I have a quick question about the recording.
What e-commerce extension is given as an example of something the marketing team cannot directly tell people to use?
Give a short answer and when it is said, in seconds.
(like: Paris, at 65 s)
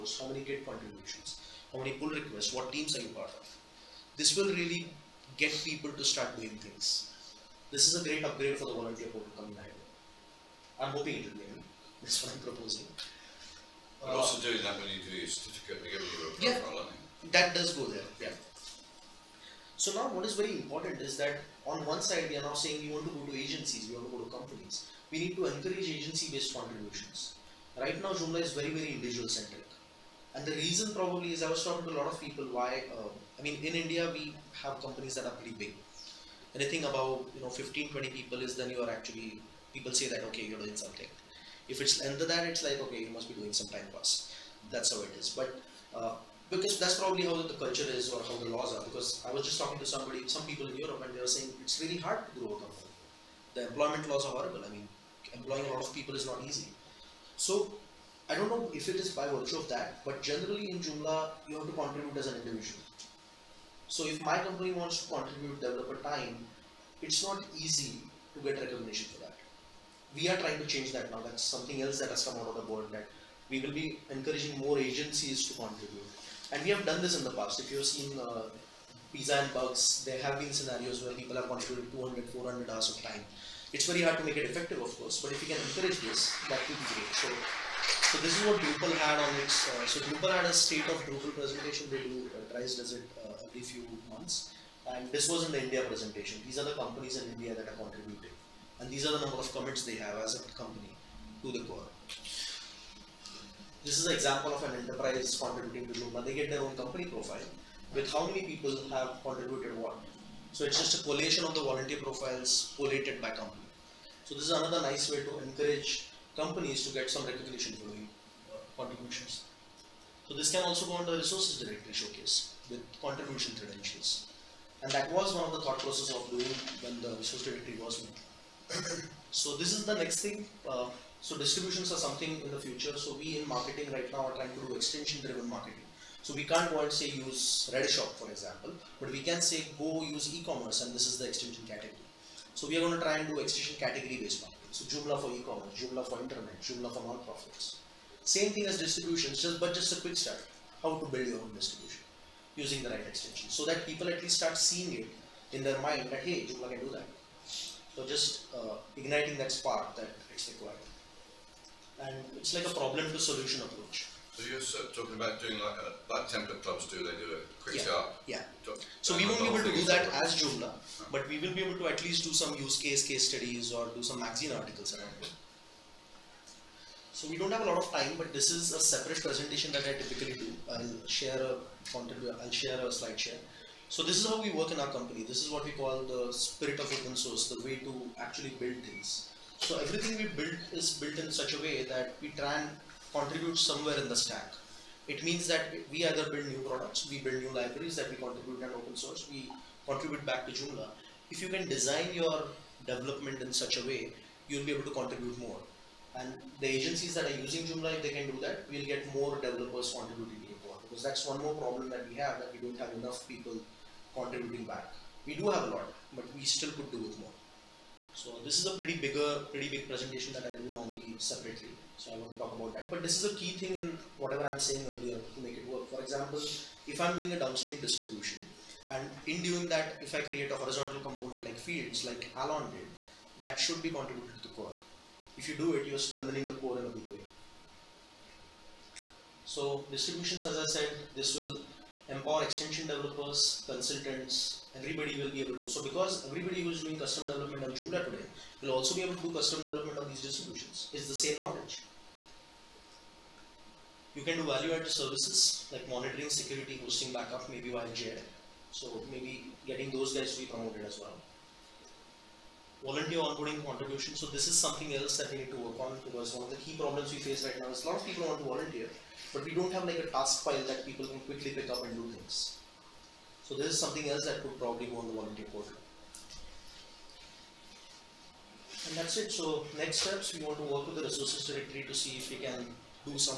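Redshop, at 137 s.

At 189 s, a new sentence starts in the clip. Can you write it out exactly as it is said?
So everything we build is built in such a way that we try and contribute somewhere in the stack.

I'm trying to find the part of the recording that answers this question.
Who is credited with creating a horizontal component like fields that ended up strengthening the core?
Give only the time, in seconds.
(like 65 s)
232 s.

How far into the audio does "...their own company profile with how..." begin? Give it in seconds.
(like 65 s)
106 s.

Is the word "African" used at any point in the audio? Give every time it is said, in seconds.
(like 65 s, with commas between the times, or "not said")
not said.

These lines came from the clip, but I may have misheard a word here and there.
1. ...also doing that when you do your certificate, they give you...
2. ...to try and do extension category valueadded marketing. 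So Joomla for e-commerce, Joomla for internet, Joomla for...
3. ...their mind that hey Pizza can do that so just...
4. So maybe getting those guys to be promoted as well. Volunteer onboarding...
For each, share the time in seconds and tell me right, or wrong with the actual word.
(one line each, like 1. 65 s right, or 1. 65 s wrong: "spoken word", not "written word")
1. 14 s right
2. 142 s wrong: "based", not "valueadded"
3. 155 s wrong: "Joomla", not "Pizza"
4. 258 s right.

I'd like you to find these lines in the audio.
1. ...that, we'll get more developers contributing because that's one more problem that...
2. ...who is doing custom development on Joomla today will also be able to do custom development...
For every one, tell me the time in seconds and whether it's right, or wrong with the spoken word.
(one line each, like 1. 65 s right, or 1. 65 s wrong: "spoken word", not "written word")
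1. 208 s right
2. 246 s right.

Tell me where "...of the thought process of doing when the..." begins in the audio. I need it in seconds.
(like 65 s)
125 s.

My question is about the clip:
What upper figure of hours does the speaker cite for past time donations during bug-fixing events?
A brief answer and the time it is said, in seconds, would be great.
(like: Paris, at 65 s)
400, at 82 s.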